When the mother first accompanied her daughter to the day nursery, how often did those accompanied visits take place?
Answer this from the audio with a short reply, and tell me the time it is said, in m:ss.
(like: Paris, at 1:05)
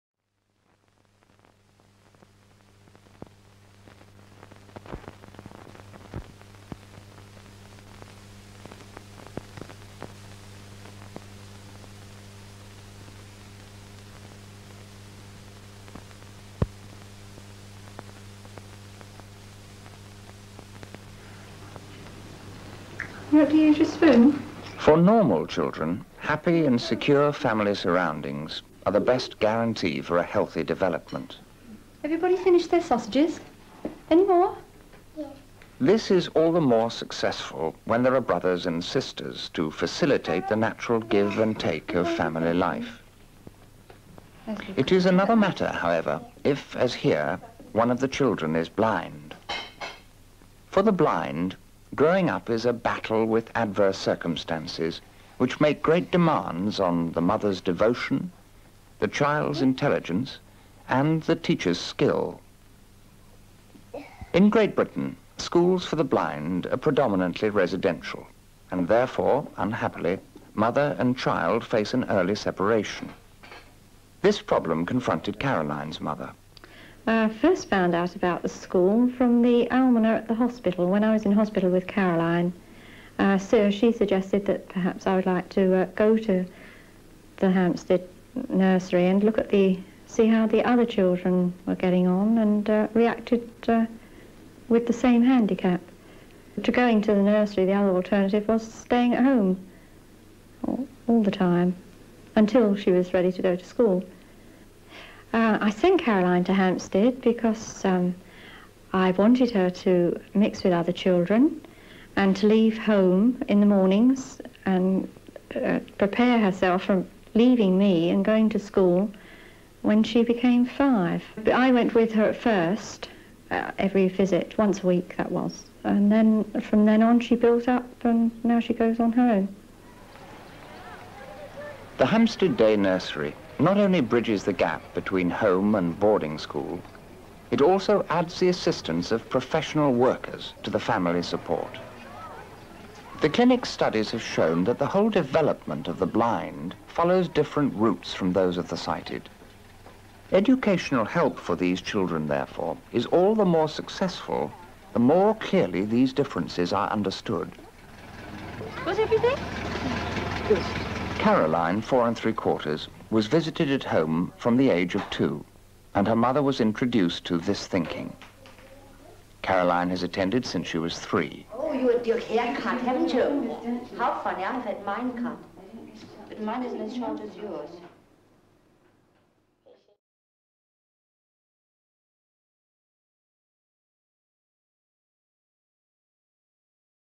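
Once a week, at 2:04.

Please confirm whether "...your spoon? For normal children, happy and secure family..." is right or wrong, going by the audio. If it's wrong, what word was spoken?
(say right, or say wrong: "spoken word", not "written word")
right.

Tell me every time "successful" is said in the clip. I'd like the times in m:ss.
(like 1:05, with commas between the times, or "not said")
0:36, 2:33.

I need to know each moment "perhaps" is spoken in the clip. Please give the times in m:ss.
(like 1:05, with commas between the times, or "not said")
1:24.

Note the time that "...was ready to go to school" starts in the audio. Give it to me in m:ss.
1:42.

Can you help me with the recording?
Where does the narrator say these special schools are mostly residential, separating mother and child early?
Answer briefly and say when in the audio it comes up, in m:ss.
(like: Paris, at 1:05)
Great Britain, at 1:04.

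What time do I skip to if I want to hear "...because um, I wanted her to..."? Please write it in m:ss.
1:47.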